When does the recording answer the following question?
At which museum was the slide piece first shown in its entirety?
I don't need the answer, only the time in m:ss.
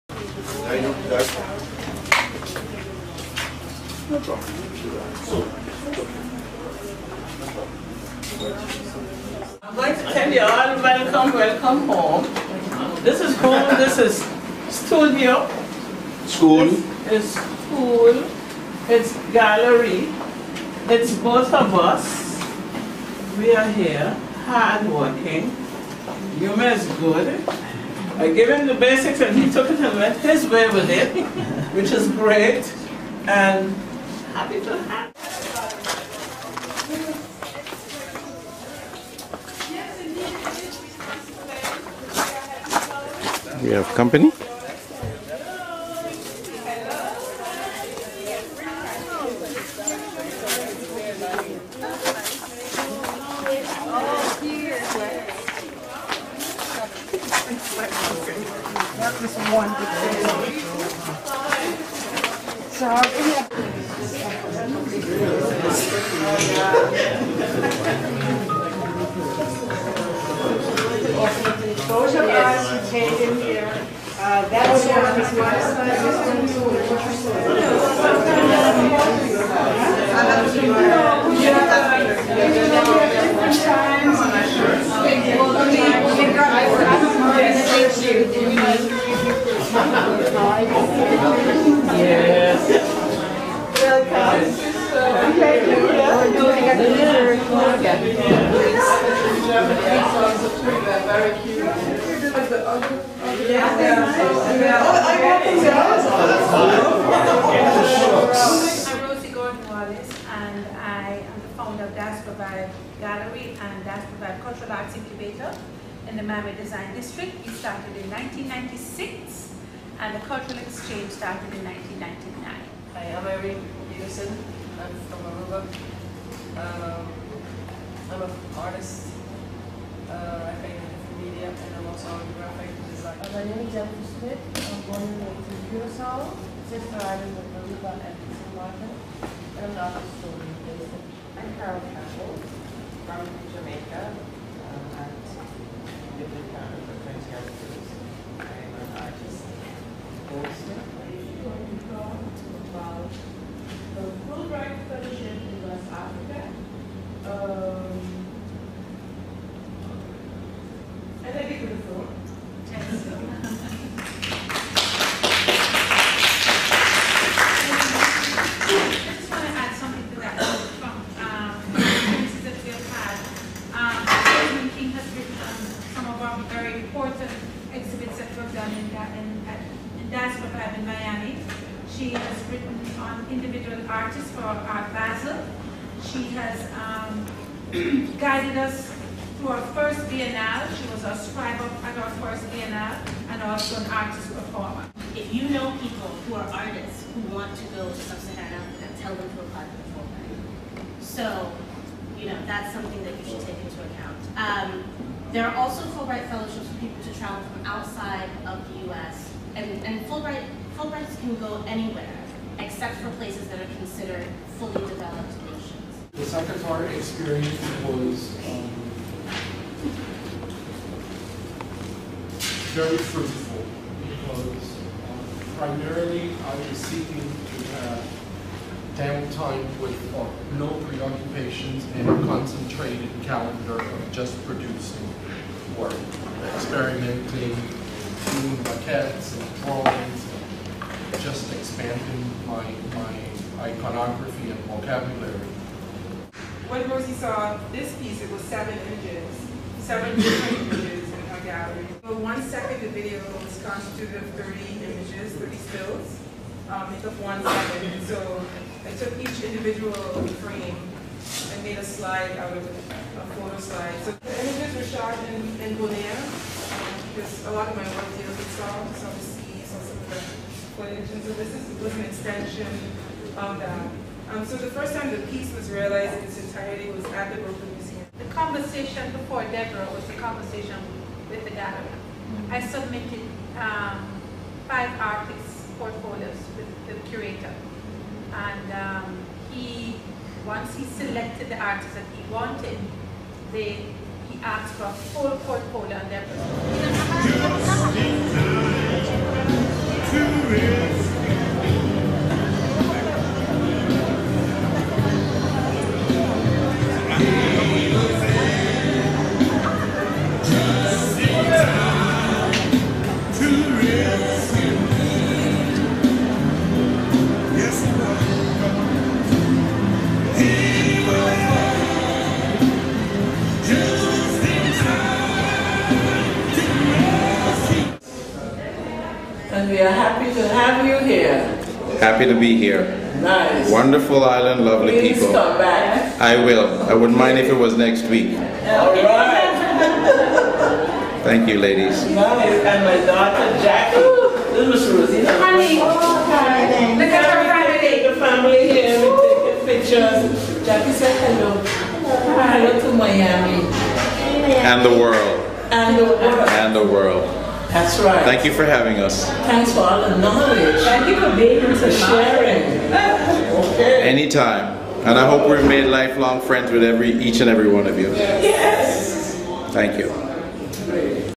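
4:37.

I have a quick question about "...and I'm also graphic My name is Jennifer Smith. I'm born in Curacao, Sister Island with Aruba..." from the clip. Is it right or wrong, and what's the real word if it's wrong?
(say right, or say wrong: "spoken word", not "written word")
right.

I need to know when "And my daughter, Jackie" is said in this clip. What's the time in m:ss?
5:42.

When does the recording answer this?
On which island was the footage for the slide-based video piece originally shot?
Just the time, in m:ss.
4:25.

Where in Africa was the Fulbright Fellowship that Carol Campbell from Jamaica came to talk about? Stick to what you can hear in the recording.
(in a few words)
West Africa.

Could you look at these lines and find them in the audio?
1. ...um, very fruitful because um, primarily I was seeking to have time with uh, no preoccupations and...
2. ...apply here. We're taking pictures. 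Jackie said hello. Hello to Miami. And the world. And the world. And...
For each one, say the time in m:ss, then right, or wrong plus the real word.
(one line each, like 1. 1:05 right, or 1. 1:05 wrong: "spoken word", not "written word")
1. 3:38 right
2. 5:48 wrong: "family", not "apply".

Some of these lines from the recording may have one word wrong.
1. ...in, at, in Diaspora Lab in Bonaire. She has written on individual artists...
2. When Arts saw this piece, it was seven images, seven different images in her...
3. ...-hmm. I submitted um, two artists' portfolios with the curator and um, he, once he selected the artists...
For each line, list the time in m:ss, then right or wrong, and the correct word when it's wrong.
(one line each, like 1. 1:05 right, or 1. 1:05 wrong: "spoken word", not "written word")
1. 2:59 wrong: "Miami", not "Bonaire"
2. 4:06 wrong: "Rosie", not "Arts"
3. 4:42 wrong: "five", not "two".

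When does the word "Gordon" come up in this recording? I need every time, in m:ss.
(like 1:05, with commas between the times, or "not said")
1:49.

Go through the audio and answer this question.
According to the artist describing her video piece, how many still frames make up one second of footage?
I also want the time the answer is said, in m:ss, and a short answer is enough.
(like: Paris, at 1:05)
30, at 4:14.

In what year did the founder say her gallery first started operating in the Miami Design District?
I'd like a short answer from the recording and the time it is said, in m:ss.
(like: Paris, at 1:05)
1996, at 1:58.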